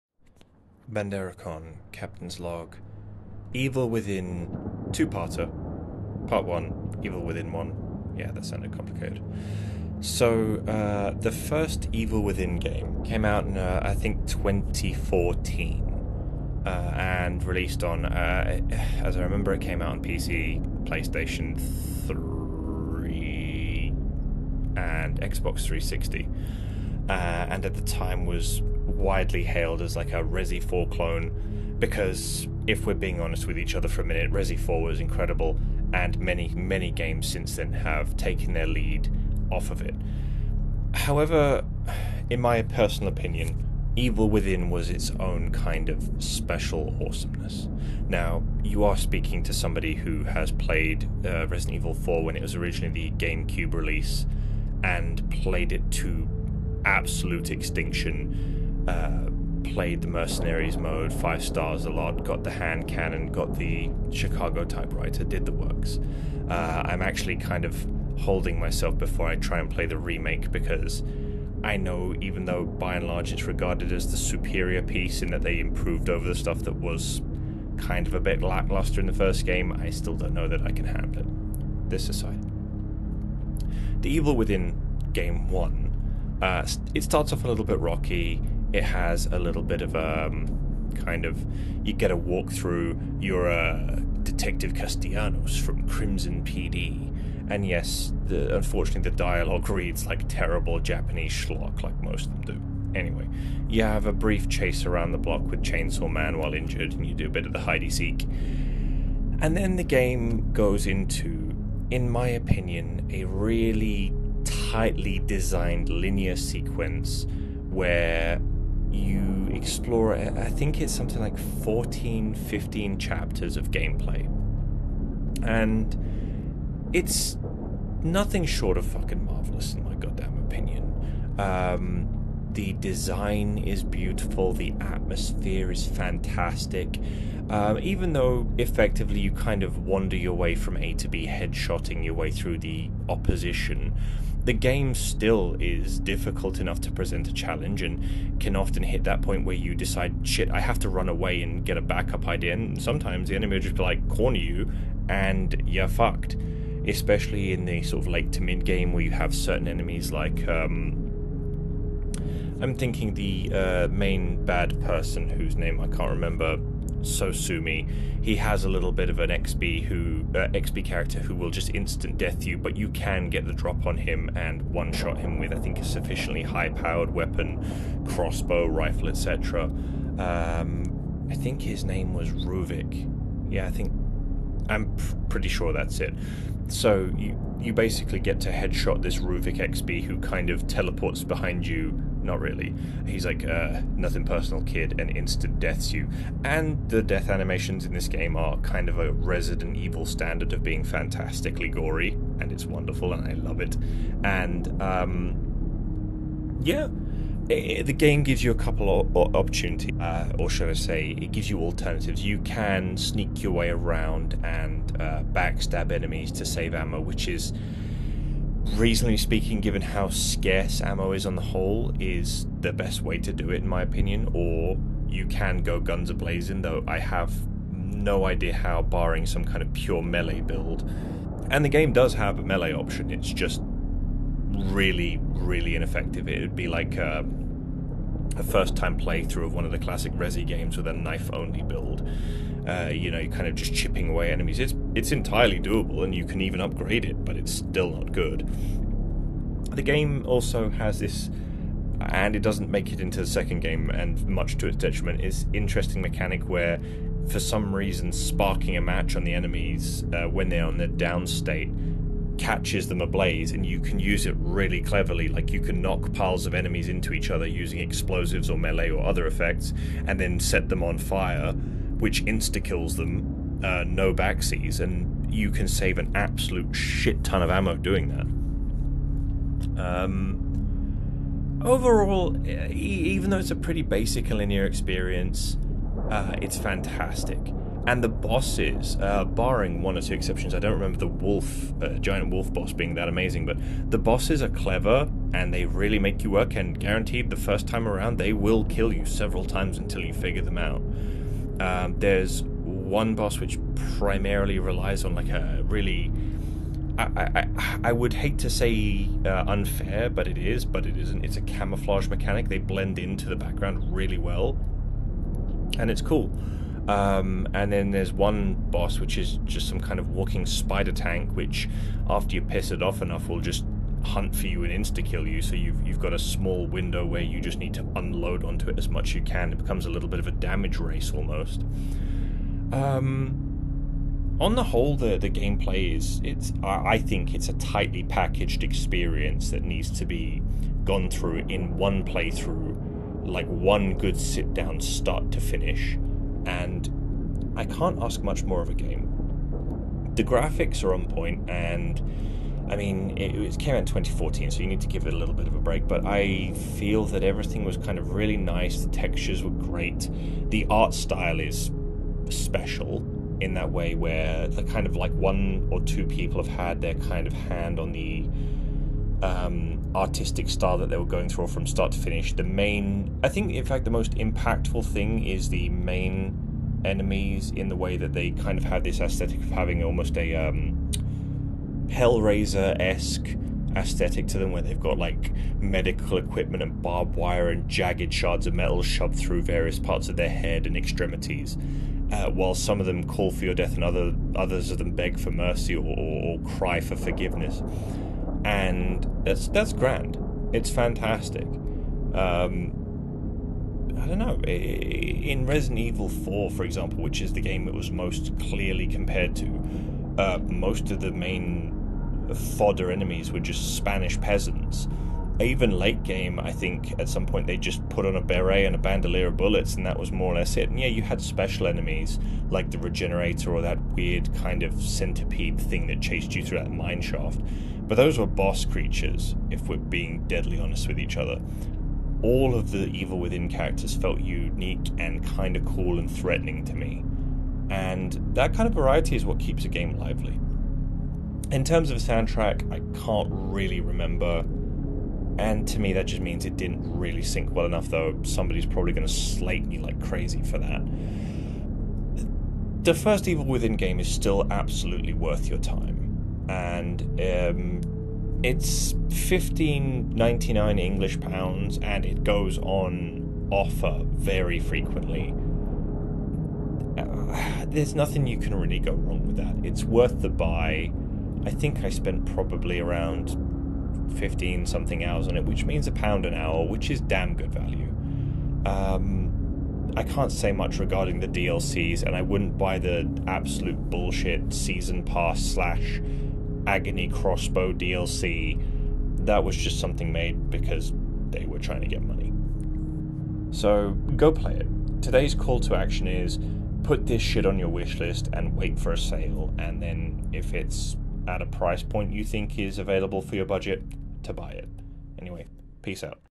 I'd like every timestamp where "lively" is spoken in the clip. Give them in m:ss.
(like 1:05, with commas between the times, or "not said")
7:19.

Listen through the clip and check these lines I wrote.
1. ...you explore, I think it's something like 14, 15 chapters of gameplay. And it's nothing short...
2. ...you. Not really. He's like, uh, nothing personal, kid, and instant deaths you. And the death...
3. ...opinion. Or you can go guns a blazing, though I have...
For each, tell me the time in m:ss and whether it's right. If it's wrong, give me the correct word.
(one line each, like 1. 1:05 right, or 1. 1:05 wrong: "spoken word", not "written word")
1. 1:58 right
2. 3:11 right
3. 3:43 right.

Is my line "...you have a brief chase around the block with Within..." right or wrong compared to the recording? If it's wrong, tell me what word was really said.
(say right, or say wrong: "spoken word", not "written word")
wrong: "Chainsaw", not "Within".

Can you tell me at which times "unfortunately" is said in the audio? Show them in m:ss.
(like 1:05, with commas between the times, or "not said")
1:38.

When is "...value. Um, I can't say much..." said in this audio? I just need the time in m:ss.
7:57.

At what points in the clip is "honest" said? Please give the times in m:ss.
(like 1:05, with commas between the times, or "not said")
0:33, 7:10.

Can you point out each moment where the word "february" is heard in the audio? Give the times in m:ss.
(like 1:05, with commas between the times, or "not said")
not said.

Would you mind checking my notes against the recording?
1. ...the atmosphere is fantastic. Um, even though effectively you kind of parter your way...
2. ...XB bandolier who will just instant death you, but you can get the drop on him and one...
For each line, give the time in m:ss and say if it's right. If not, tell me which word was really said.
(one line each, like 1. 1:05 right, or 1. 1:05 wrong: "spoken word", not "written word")
1. 2:14 wrong: "wander", not "parter"
2. 2:50 wrong: "character", not "bandolier".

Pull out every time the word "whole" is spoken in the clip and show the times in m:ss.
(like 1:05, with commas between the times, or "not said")
3:41, 5:34.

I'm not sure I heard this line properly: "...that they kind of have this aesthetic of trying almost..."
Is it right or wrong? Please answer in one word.
wrong.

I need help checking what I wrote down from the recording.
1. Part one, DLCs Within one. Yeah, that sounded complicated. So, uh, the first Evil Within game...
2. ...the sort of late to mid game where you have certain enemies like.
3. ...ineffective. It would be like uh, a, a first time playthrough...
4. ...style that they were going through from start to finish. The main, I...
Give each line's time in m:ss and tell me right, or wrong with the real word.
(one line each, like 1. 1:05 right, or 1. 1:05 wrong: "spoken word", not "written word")
1. 0:06 wrong: "Evil", not "DLCs"
2. 2:37 right
3. 3:55 right
4. 6:10 right.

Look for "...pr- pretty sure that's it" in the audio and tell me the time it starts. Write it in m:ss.
3:04.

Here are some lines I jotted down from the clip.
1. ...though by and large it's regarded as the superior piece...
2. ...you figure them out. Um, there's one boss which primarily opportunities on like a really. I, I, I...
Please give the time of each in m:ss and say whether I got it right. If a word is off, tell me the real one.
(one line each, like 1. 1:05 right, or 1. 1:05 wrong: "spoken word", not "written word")
1. 1:12 right
2. 5:00 wrong: "relies", not "opportunities".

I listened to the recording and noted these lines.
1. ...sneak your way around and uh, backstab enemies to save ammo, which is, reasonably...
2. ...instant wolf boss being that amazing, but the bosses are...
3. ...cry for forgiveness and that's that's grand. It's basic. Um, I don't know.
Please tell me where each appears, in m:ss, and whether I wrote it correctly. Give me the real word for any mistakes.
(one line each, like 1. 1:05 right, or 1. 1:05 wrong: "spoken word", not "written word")
1. 3:32 right
2. 4:51 wrong: "giant", not "instant"
3. 6:36 wrong: "fantastic", not "basic".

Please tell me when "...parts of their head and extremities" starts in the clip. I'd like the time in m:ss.
6:29.